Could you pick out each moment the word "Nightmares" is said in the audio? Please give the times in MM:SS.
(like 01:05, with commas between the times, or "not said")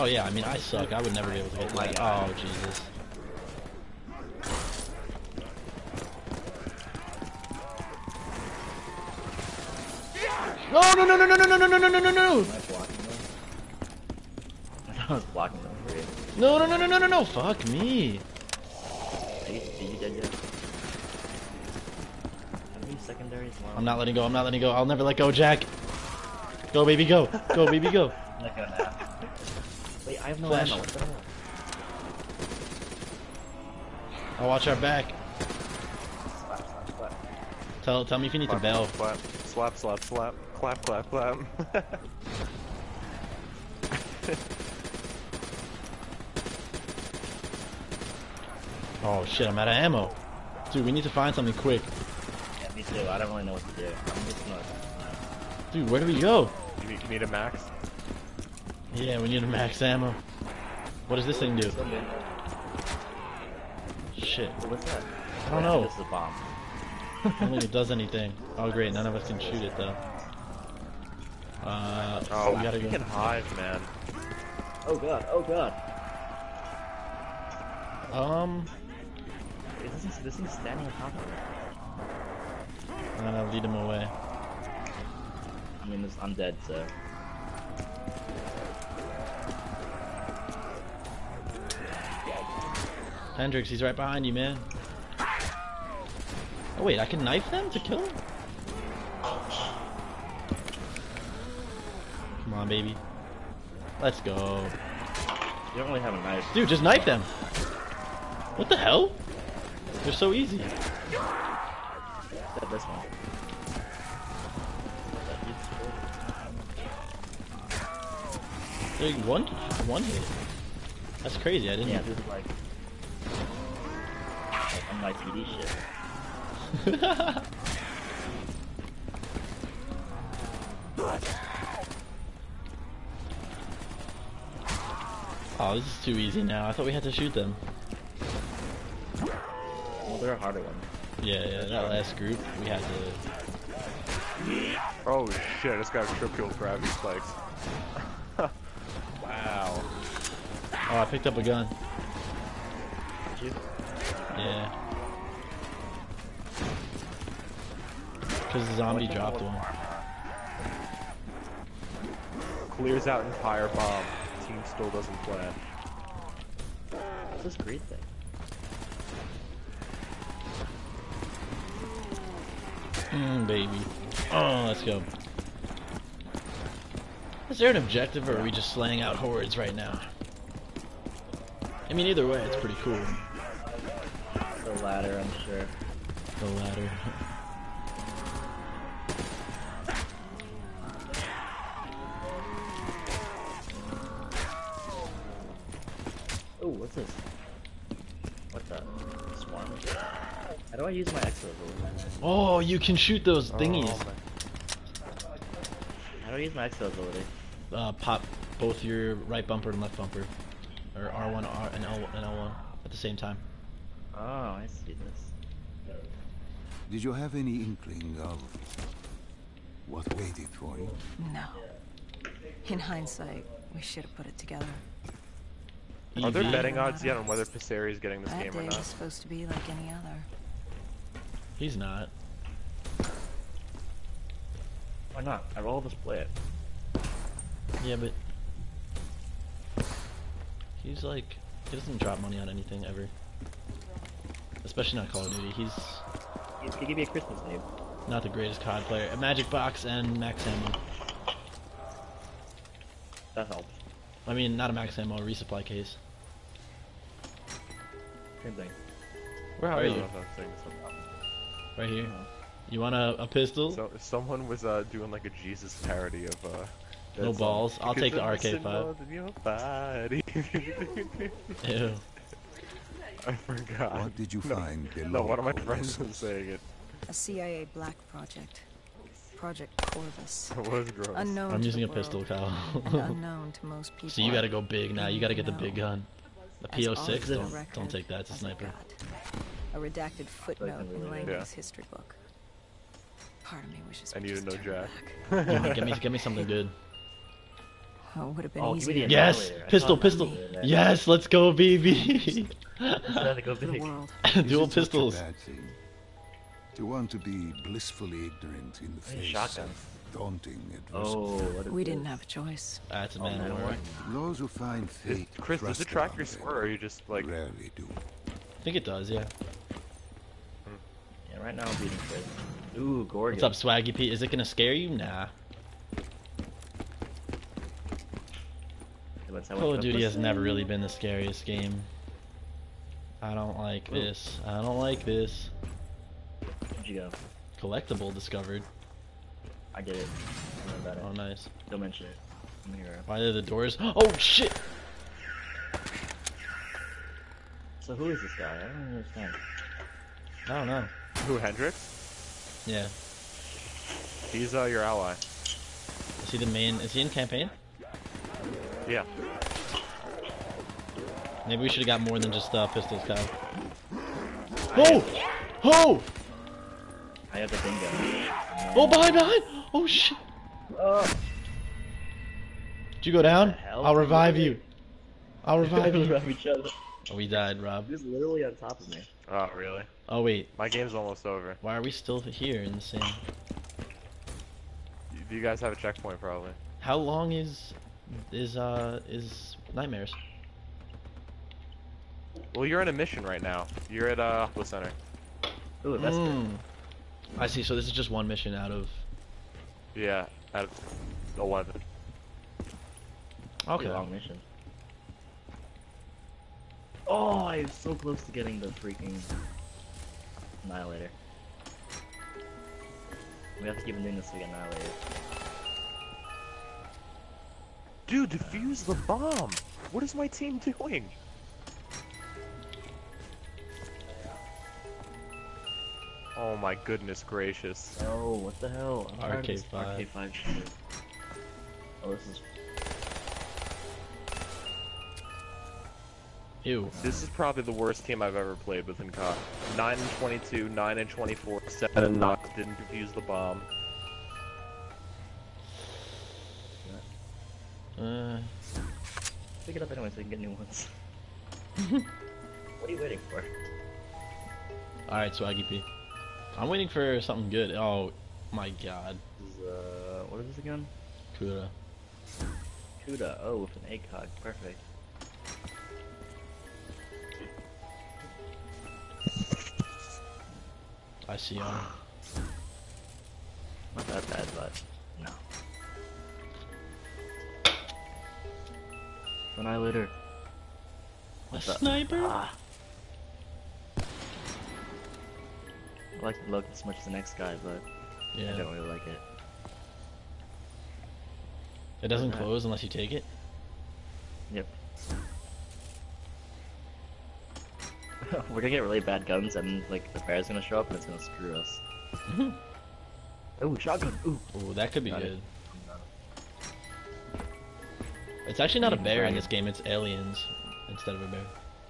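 06:29.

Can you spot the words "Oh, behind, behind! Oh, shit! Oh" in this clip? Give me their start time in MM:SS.
06:08.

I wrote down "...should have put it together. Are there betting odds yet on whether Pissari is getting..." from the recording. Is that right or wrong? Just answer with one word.
right.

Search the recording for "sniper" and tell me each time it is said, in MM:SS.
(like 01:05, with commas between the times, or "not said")
04:48, 08:01.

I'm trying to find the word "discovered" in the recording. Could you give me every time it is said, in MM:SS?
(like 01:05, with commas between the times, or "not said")
05:38.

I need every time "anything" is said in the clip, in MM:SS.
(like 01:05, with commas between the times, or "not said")
01:07, 04:02.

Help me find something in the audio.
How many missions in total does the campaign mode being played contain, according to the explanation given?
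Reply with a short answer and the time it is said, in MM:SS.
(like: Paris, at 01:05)
11, at 06:40.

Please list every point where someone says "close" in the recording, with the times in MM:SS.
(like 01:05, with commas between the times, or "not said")
06:47, 08:12.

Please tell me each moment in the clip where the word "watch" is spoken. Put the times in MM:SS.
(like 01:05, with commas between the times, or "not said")
00:34.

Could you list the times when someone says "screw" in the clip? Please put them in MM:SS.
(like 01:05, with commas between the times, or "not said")
08:21.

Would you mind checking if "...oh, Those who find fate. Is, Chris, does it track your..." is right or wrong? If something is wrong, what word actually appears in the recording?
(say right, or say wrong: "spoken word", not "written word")
right.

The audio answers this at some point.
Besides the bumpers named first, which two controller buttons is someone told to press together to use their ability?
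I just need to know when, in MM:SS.
03:31.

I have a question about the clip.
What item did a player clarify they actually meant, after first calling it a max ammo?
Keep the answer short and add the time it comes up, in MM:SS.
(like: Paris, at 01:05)
a resupply case, at 04:15.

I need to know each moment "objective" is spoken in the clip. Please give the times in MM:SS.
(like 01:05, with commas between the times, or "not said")
02:57.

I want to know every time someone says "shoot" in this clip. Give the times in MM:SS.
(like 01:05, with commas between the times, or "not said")
01:09, 02:17, 03:22.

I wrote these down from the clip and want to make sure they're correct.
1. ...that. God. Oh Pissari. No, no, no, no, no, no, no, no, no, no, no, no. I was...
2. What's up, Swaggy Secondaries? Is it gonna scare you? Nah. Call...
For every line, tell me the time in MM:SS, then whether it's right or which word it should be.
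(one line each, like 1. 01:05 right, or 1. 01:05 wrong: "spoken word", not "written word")
1. 00:01 wrong: "Jesus", not "Pissari"
2. 05:23 wrong: "Pete", not "Secondaries".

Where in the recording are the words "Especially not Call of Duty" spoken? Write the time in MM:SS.
04:04.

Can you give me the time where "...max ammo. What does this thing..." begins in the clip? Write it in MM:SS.
00:59.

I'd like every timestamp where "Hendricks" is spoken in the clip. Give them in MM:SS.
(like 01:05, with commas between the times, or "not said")
01:33, 05:51.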